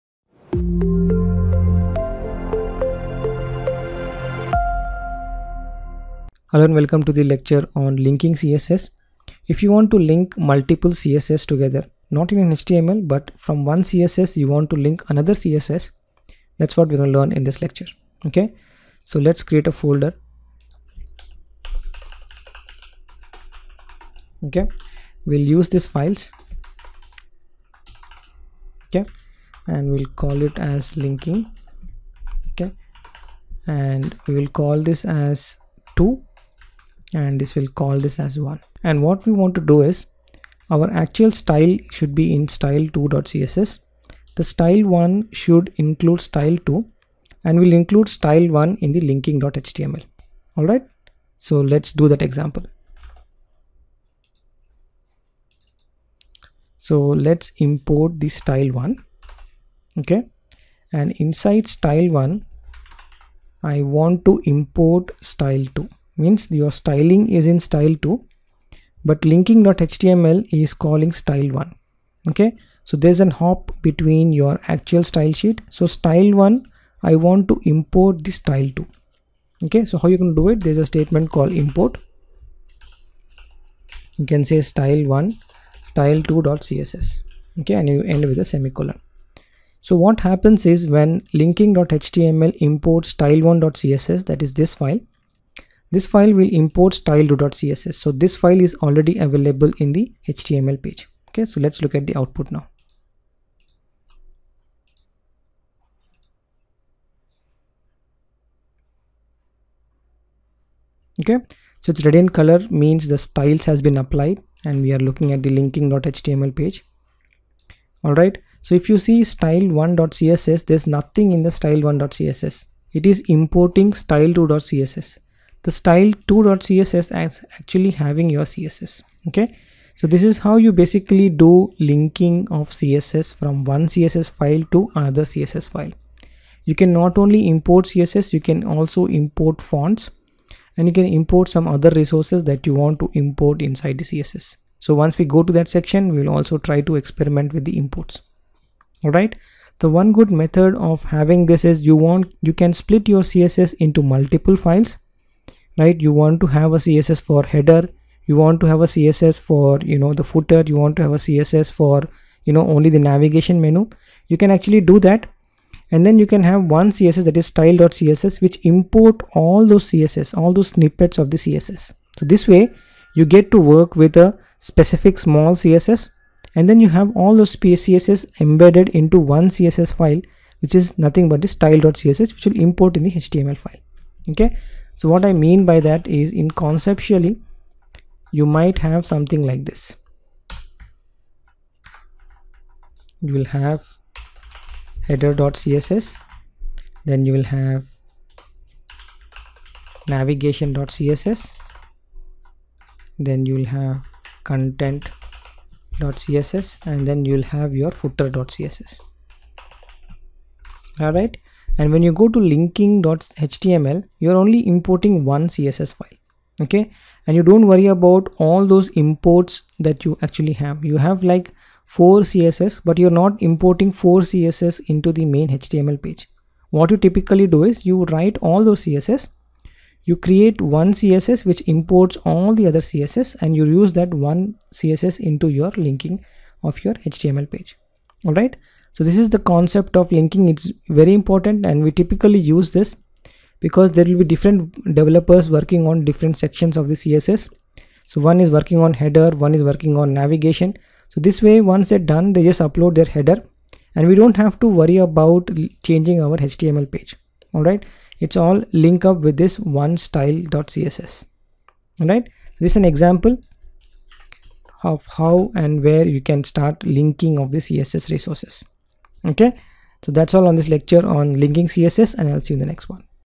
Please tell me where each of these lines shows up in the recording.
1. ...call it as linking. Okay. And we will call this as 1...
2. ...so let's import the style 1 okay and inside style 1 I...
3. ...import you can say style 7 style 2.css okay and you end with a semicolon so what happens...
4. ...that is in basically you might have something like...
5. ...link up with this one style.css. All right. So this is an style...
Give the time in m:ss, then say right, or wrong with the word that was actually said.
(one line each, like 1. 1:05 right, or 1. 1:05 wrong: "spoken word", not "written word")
1. 0:30 wrong: "2", not "1"
2. 0:56 right
3. 1:21 wrong: "1", not "7"
4. 3:05 wrong: "conceptually", not "basically"
5. 4:18 wrong: "example", not "style".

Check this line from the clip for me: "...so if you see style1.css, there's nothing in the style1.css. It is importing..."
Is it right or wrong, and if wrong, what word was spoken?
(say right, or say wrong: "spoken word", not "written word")
right.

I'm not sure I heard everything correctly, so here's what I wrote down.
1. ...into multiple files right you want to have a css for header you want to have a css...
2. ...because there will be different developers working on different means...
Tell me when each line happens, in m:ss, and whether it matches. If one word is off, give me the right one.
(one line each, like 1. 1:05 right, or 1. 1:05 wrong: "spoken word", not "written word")
1. 2:33 right
2. 4:03 wrong: "sections", not "means".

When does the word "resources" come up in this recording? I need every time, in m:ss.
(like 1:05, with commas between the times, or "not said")
2:21, 4:28.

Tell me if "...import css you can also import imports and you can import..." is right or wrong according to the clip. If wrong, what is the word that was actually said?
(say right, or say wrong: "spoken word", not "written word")
wrong: "fonts", not "imports".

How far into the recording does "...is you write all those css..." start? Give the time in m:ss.
3:47.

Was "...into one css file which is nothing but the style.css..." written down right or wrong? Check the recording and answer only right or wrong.
right.